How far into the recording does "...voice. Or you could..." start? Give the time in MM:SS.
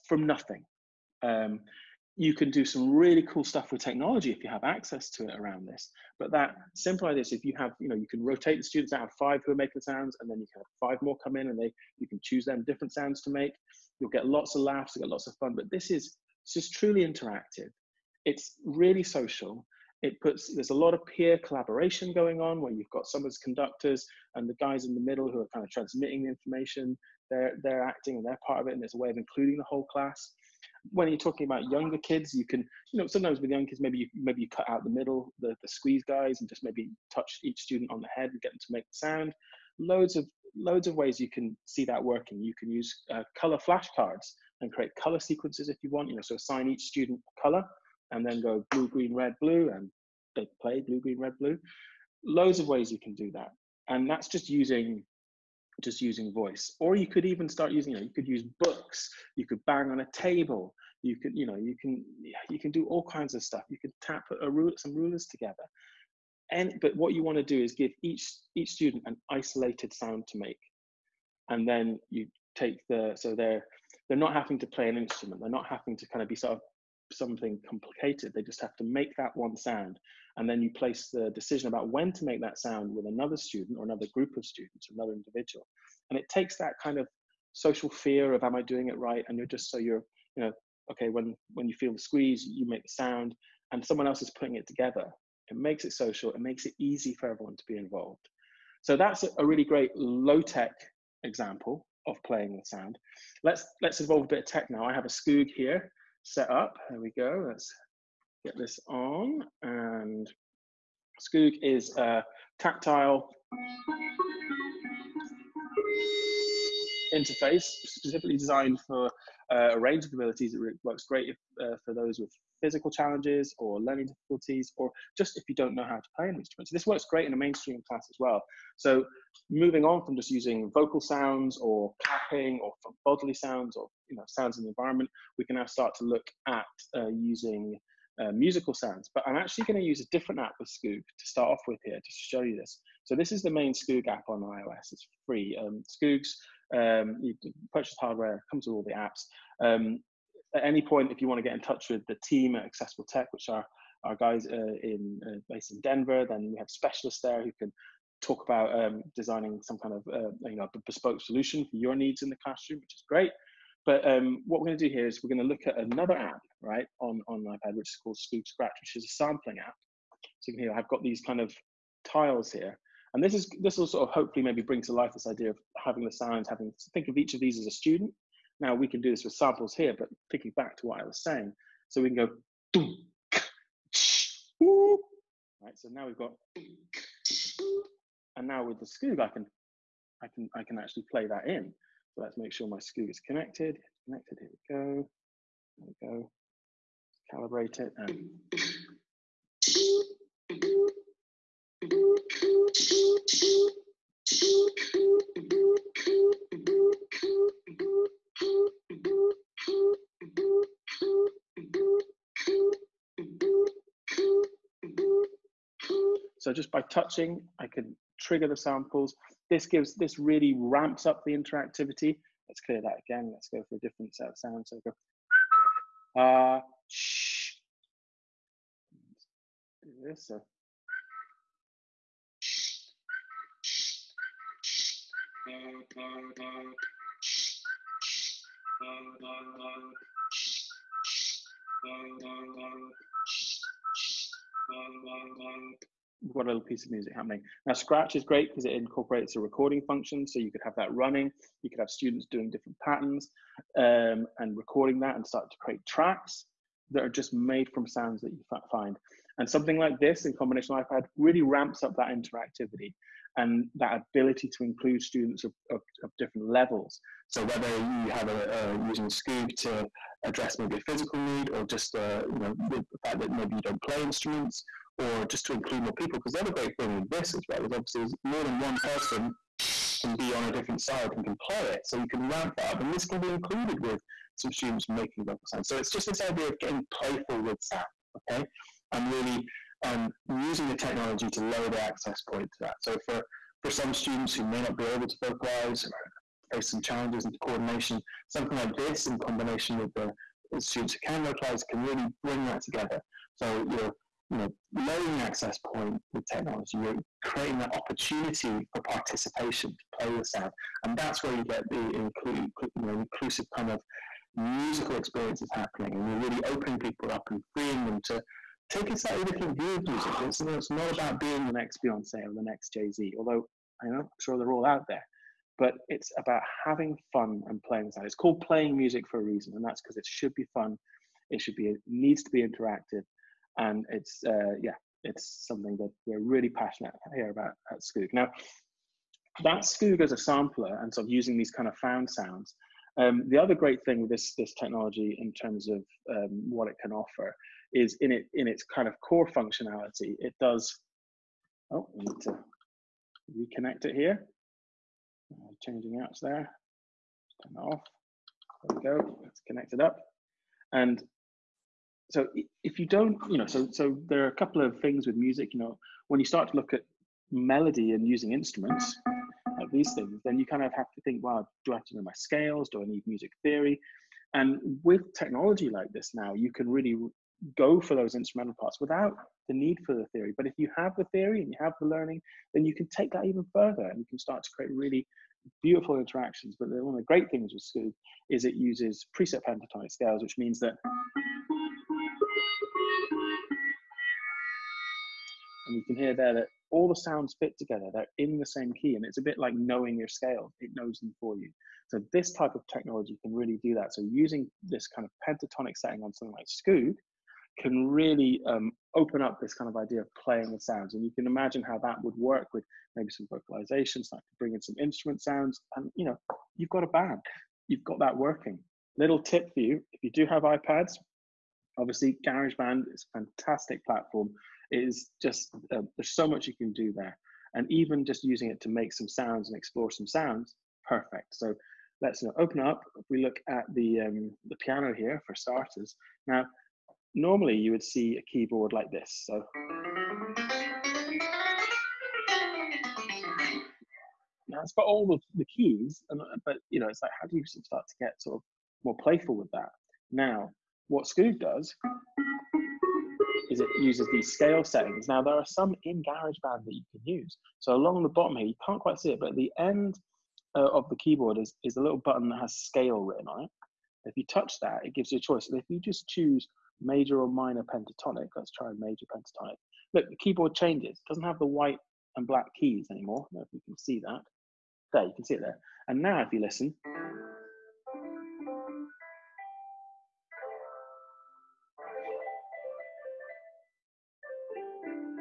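00:56.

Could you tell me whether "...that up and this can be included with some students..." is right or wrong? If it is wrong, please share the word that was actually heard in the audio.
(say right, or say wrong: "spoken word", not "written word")
right.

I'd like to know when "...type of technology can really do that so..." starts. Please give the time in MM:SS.
06:42.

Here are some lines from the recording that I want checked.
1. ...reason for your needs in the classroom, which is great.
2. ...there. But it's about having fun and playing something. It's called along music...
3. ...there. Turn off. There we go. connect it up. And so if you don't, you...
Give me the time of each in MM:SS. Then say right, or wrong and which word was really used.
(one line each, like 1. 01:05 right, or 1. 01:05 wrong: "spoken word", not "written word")
1. 02:41 wrong: "solution", not "reason"
2. 05:24 wrong: "playing", not "along"
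3. 05:56 right.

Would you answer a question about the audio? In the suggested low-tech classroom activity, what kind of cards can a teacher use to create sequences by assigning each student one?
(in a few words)
Color flashcards.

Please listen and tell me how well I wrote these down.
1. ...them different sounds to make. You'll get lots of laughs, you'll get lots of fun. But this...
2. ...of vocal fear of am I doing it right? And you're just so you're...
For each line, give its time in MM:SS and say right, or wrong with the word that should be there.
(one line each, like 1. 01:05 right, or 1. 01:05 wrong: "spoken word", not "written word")
1. 00:12 right
2. 01:26 wrong: "social", not "vocal".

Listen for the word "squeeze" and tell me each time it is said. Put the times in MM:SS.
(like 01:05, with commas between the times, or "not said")
00:35, 01:31.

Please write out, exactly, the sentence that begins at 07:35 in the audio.
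Now there are some in GarageBand that you can use.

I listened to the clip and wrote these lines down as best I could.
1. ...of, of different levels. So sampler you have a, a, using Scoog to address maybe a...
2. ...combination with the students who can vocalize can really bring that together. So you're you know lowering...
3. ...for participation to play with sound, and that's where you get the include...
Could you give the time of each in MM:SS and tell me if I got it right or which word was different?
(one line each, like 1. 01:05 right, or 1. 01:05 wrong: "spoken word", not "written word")
1. 04:25 wrong: "whether", not "sampler"
2. 04:59 right
3. 05:08 right.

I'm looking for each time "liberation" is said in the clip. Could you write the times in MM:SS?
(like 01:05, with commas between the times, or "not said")
not said.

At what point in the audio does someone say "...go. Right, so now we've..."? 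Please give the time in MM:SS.
03:02.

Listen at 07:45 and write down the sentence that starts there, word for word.
And if you just choose major or minor pentatonic, let's try major pentatonic.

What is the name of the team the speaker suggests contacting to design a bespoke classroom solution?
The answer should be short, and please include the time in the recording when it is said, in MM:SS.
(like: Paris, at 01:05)
Accessible Tech, at 02:32.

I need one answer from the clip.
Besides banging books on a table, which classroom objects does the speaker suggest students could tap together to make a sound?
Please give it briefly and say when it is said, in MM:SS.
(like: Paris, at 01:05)
Rulers, at 01:04.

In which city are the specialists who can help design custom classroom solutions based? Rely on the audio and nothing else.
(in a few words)
Denver.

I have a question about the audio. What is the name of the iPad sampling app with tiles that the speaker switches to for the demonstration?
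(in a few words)
Skoog Scratch.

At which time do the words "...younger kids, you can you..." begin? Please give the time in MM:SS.
00:31.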